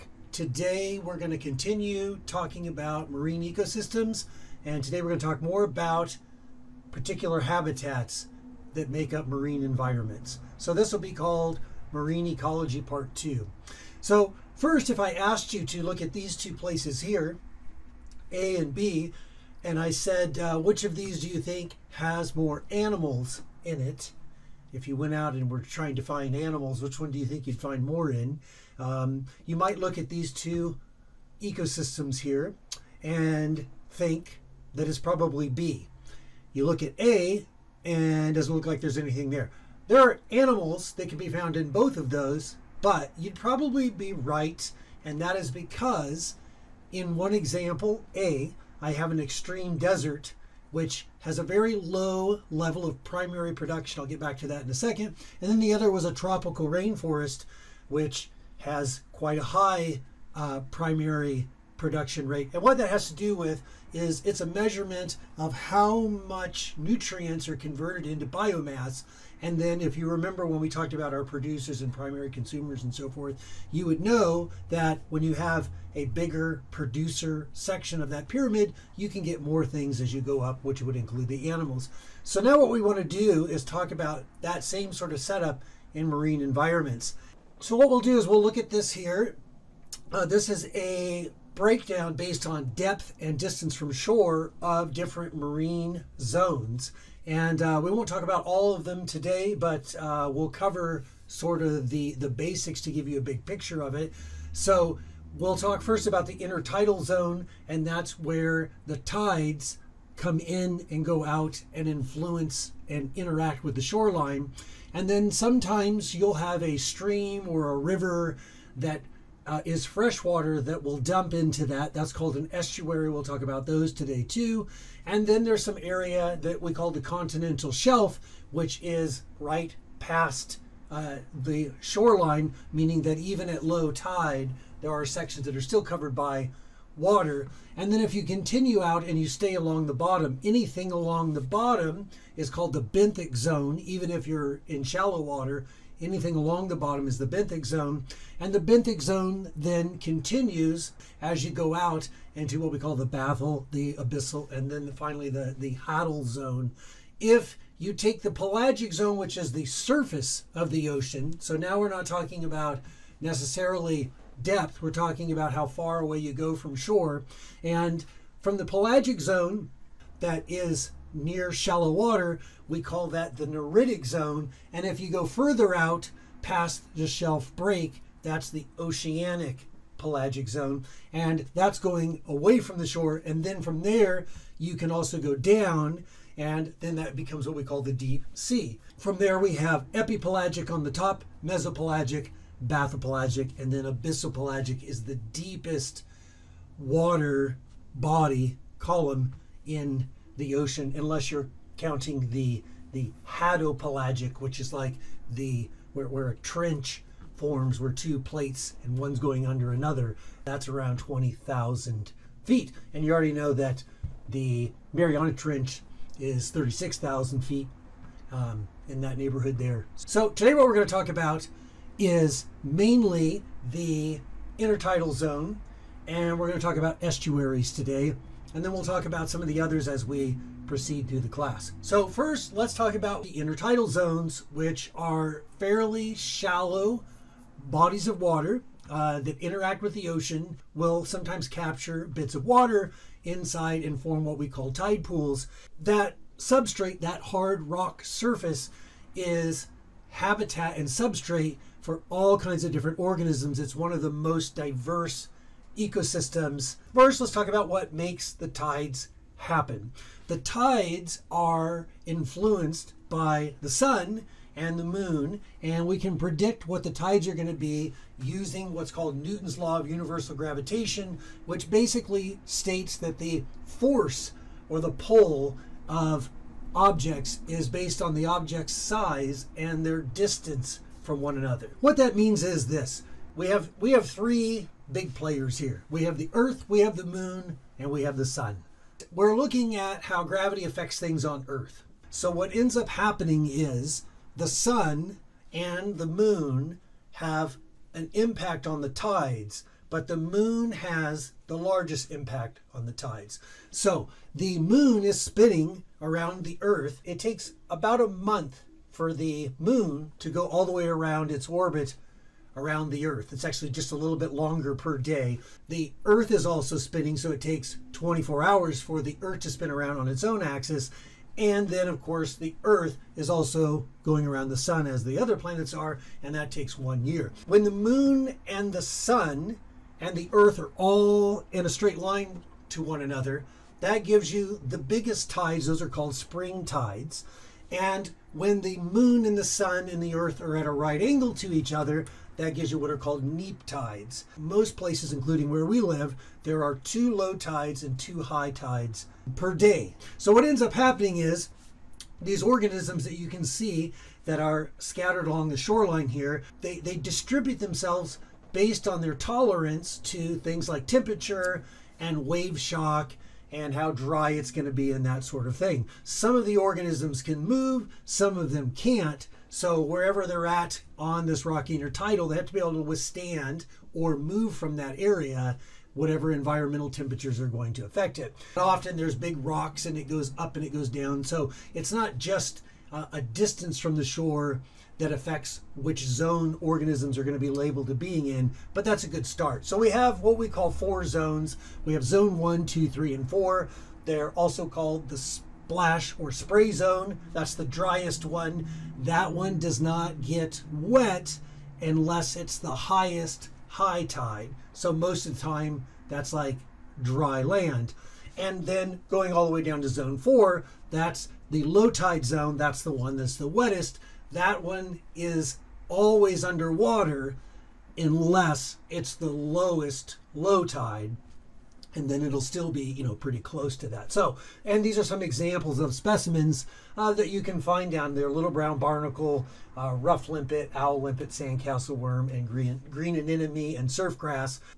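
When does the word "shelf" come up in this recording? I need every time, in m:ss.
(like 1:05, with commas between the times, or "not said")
2:07, 2:57.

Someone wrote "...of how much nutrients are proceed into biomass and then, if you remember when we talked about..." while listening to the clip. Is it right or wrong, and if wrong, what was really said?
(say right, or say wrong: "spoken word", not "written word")
wrong: "converted", not "proceed".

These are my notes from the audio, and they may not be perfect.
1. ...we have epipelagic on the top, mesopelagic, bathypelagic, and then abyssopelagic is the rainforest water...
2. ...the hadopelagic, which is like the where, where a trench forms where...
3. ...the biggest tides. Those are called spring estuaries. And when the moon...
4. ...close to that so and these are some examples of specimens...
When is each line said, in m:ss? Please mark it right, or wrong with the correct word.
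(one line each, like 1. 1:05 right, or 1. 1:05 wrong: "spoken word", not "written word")
1. 3:09 wrong: "deepest", not "rainforest"
2. 3:22 right
3. 5:34 wrong: "tides", not "estuaries"
4. 7:03 right.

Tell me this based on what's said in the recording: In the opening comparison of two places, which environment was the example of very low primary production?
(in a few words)
Extreme desert.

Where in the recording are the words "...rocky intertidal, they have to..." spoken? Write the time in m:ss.
6:11.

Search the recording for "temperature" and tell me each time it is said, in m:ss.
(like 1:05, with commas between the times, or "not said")
6:00, 6:16.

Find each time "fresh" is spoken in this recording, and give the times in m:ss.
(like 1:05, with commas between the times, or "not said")
1:59.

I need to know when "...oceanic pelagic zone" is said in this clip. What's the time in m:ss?
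2:58.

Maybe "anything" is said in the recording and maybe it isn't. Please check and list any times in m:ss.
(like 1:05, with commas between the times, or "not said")
0:38, 2:20, 2:26.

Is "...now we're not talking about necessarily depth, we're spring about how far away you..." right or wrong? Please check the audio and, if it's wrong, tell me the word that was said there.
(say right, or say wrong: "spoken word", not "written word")
wrong: "talking", not "spring".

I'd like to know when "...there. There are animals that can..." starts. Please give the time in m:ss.
0:39.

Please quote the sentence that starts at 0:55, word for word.
And then the other was a tropical rainforest, which has quite a high uh, primary production rate.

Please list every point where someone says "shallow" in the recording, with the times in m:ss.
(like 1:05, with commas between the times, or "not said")
2:24, 2:51, 3:56.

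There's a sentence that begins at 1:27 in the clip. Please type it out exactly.
So, what we'll do is we'll look at this here.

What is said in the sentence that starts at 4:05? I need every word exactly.
That substrate, that hard rock surface, is habitat and substrate for all kinds of different organisms.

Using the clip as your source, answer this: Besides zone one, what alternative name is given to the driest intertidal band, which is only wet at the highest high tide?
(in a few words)
Splash or spray zone.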